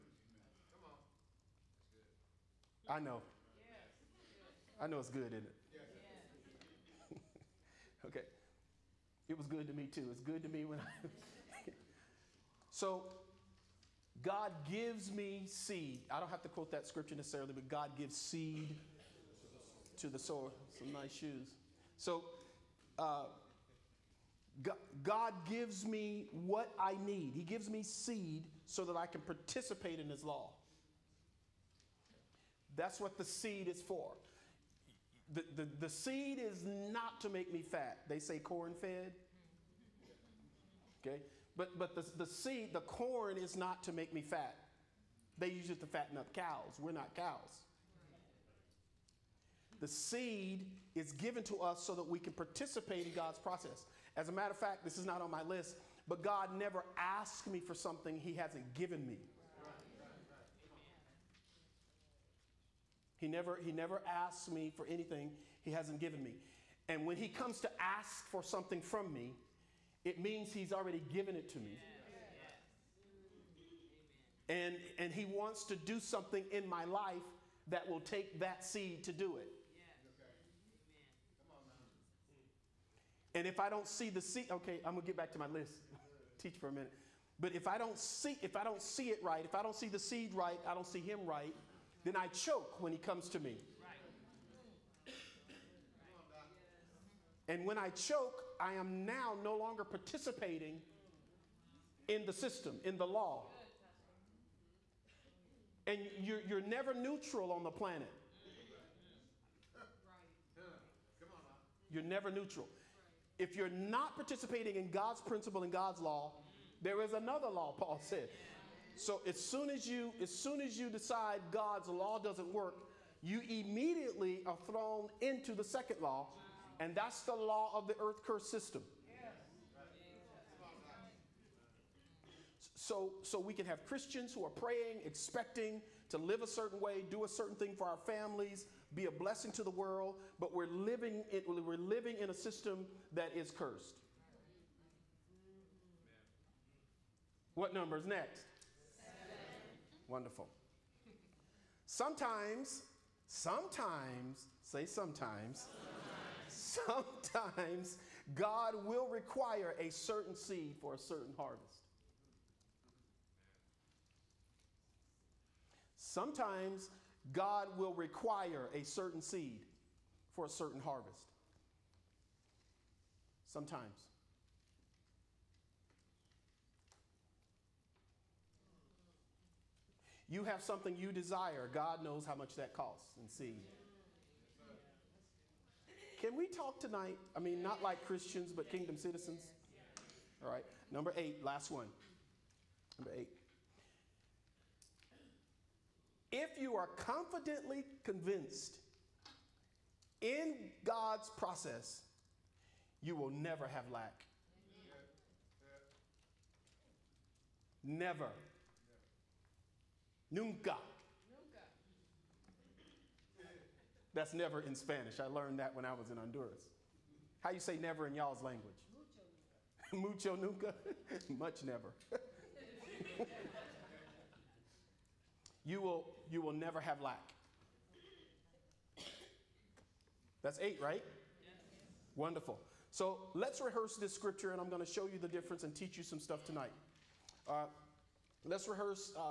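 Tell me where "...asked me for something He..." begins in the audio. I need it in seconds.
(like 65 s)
56 s.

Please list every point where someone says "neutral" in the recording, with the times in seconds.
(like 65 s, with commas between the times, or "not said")
106 s, 112 s.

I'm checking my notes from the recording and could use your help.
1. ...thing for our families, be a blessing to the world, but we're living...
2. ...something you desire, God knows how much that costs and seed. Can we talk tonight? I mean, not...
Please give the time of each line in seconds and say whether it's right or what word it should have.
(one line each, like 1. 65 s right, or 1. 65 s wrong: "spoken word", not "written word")
1. 137 s right
2. 180 s right.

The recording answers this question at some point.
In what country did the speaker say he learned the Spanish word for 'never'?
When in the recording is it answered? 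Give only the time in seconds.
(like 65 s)
216 s.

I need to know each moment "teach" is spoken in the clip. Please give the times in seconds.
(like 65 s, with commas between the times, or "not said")
86 s, 235 s.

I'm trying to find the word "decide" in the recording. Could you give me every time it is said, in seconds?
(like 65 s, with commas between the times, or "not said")
120 s.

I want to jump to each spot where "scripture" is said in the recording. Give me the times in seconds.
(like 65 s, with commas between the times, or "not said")
16 s, 234 s.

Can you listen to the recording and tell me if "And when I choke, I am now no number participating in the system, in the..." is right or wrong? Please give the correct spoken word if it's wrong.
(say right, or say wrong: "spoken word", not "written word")
wrong: "longer", not "number".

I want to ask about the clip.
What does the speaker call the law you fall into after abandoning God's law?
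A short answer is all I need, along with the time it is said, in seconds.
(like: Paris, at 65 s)
Earth curse system, at 127 s.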